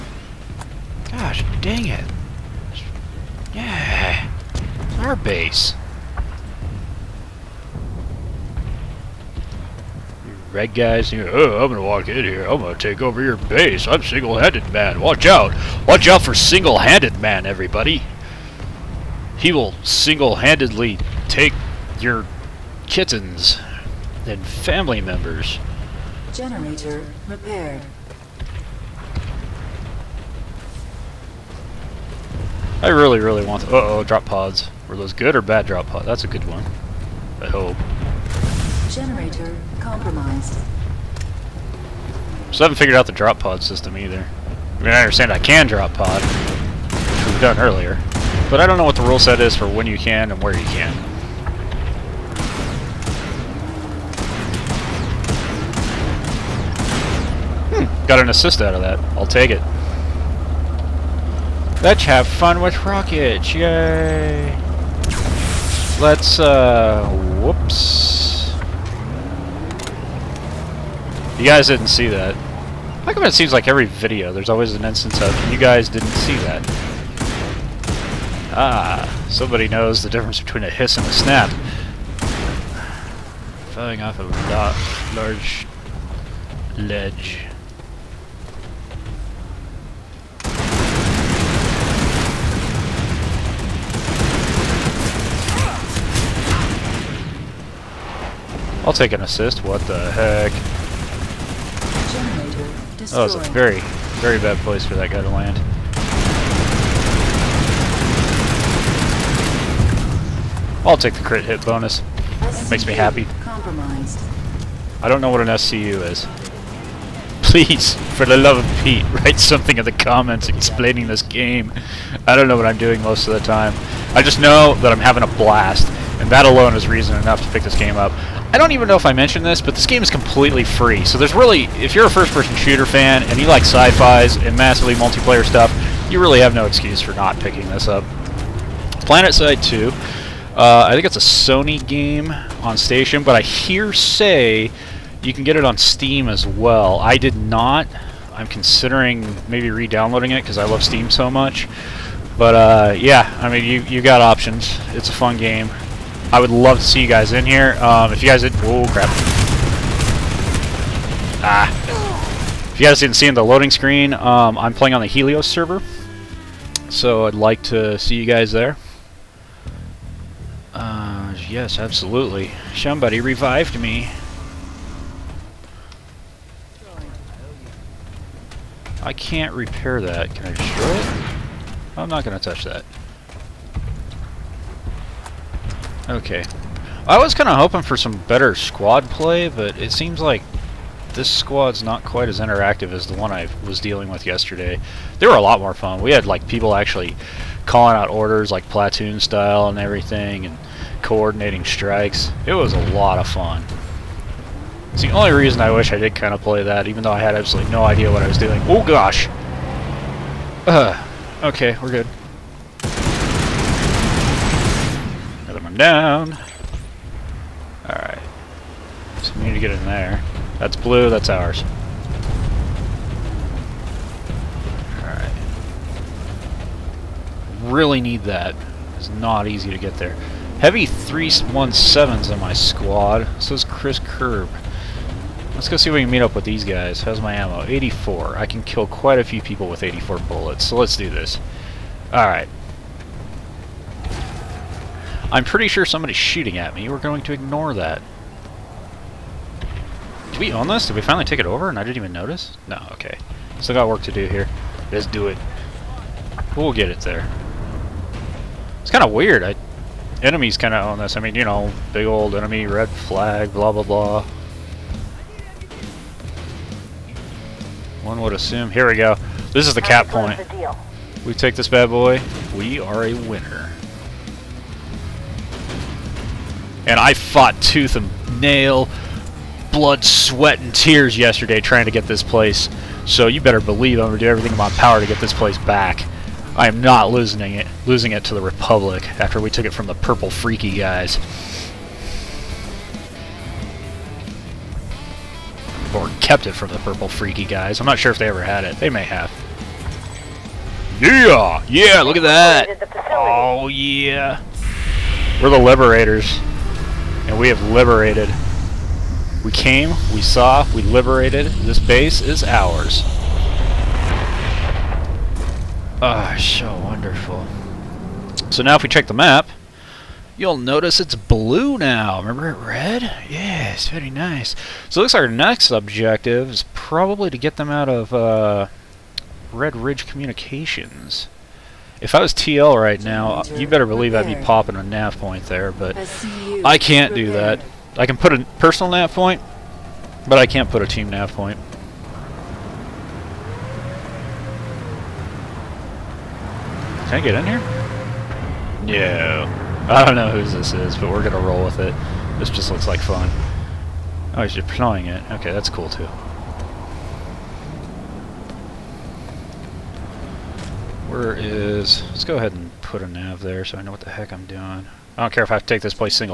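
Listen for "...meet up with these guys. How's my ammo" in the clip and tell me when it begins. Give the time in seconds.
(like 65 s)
236 s.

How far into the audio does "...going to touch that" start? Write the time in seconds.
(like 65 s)
182 s.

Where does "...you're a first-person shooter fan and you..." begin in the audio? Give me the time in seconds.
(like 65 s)
131 s.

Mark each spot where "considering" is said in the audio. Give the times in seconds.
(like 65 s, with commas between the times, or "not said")
148 s.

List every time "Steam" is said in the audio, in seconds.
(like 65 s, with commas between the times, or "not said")
145 s, 150 s.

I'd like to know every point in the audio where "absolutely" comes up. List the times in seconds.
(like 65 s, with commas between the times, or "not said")
171 s, 207 s.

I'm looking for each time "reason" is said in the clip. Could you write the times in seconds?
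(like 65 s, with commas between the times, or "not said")
126 s, 205 s.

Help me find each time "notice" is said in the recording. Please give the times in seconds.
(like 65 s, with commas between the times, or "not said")
252 s, 320 s.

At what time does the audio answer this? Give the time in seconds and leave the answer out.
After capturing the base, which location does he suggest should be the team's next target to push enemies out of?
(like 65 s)
329 s.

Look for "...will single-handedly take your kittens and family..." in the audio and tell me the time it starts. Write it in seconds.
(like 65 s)
19 s.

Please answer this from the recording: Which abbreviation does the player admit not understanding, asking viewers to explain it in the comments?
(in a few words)
SCU.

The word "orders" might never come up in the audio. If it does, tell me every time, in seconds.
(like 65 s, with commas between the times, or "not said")
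198 s.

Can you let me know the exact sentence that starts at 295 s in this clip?
Or kept it from the purple freaky guys.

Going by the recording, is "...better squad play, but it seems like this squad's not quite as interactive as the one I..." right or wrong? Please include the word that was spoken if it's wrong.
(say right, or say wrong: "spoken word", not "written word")
right.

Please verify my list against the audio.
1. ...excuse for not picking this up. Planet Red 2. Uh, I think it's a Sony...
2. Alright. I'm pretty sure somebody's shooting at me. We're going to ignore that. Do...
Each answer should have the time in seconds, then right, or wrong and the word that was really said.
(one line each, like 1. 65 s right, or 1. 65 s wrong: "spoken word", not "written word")
1. 136 s wrong: "Side", not "Red"
2. 242 s right.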